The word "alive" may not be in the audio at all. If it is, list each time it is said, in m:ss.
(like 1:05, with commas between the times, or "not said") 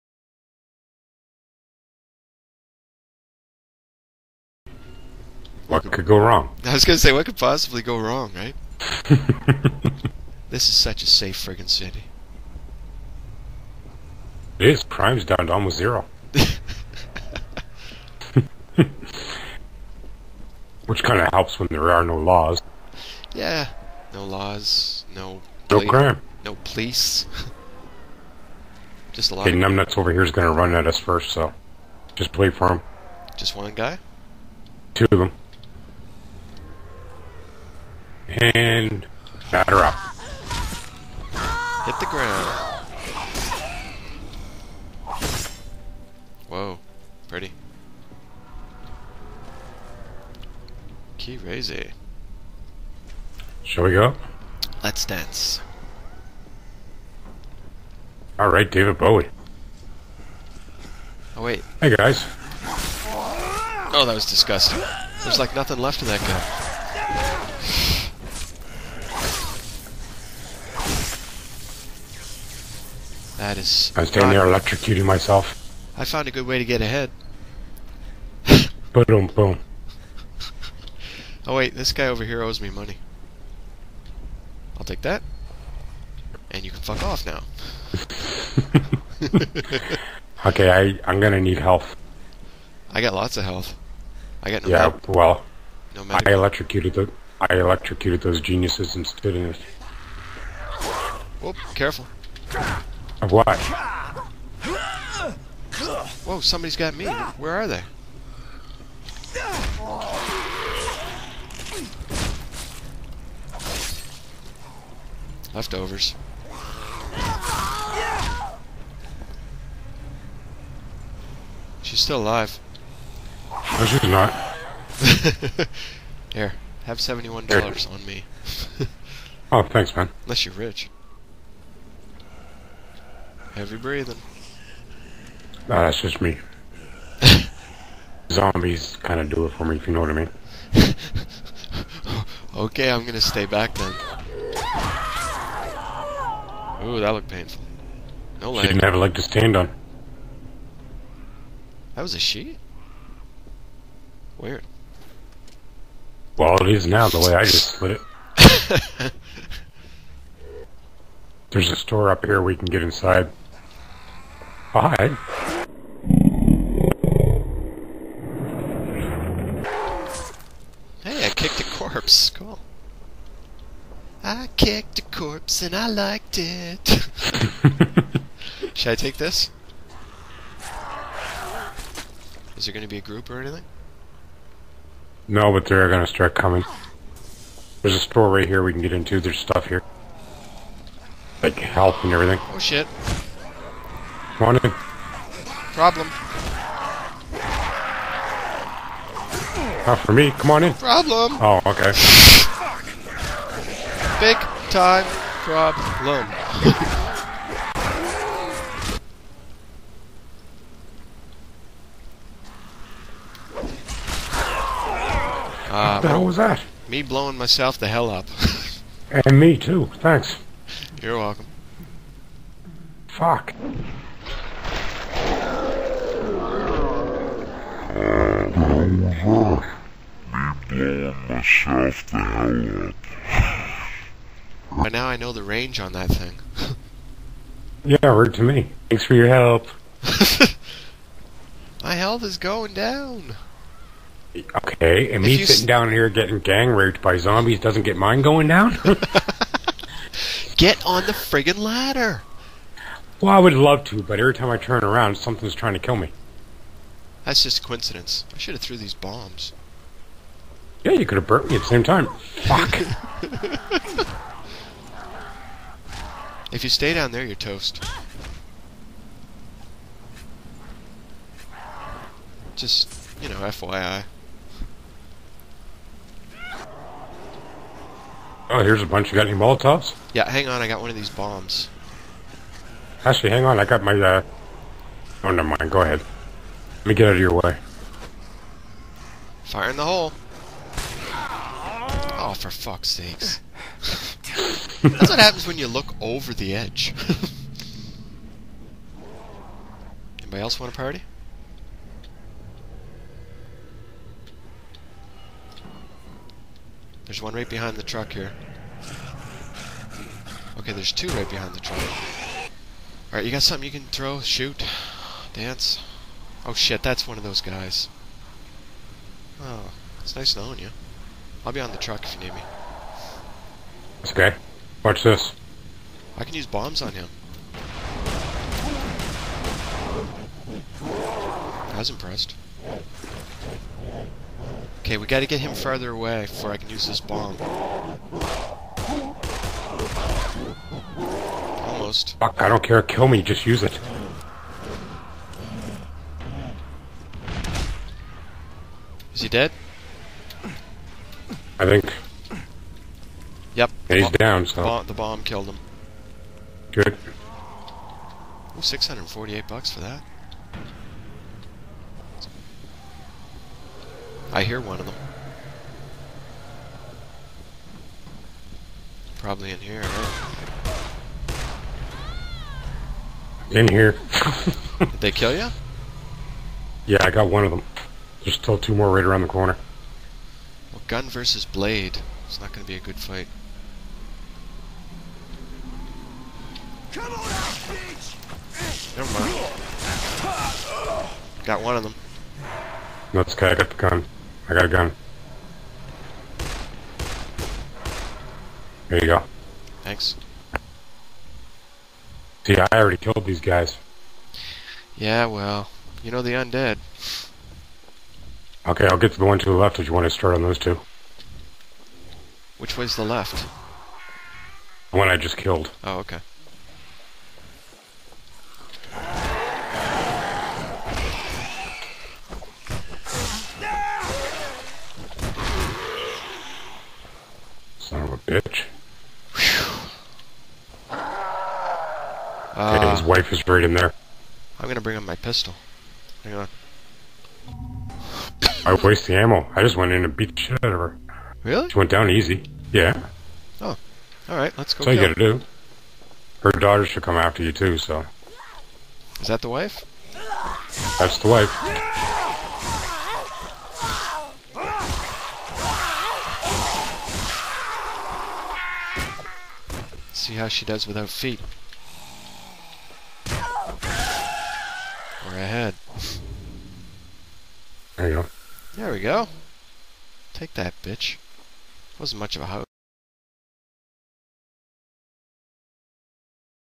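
2:02.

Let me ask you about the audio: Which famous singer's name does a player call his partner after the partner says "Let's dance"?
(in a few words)
David Bowie.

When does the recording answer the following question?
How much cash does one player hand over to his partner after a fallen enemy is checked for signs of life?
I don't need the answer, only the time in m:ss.
2:06.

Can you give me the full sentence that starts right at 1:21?
Oh wait, this guy over here owes me money.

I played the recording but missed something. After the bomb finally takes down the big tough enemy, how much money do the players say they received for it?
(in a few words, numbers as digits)
648 bucks.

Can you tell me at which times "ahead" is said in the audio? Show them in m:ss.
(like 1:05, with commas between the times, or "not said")
1:16, 4:45, 7:45.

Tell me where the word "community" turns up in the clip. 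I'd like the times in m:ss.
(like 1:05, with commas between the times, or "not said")
not said.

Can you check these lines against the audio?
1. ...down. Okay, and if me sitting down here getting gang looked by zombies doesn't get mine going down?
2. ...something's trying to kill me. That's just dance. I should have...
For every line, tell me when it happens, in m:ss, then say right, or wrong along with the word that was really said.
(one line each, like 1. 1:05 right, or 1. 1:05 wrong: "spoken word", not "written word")
1. 4:02 wrong: "raped", not "looked"
2. 4:15 wrong: "coincidence", not "dance".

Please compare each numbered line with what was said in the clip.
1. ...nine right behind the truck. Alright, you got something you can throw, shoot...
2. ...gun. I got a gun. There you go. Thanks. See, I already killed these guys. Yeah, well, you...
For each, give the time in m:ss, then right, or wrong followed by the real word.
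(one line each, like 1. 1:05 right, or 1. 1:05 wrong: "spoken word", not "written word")
1. 5:10 wrong: "two", not "nine"
2. 6:33 right.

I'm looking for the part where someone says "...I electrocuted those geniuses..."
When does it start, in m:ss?
1:37.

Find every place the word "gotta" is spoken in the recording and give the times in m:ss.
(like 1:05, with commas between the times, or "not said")
5:35, 7:25.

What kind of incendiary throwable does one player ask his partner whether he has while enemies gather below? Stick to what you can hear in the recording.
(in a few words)
Molotovs.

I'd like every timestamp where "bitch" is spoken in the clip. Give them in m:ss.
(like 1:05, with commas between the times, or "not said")
6:27, 7:08, 7:50.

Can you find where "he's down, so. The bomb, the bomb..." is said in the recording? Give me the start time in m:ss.
5:53.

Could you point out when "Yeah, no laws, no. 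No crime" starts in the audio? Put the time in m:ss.
0:23.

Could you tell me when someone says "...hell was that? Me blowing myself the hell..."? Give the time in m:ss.
3:36.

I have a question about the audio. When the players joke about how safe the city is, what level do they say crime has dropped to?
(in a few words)
almost zero.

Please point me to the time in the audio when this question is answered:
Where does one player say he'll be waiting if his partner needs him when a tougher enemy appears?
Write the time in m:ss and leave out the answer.
5:21.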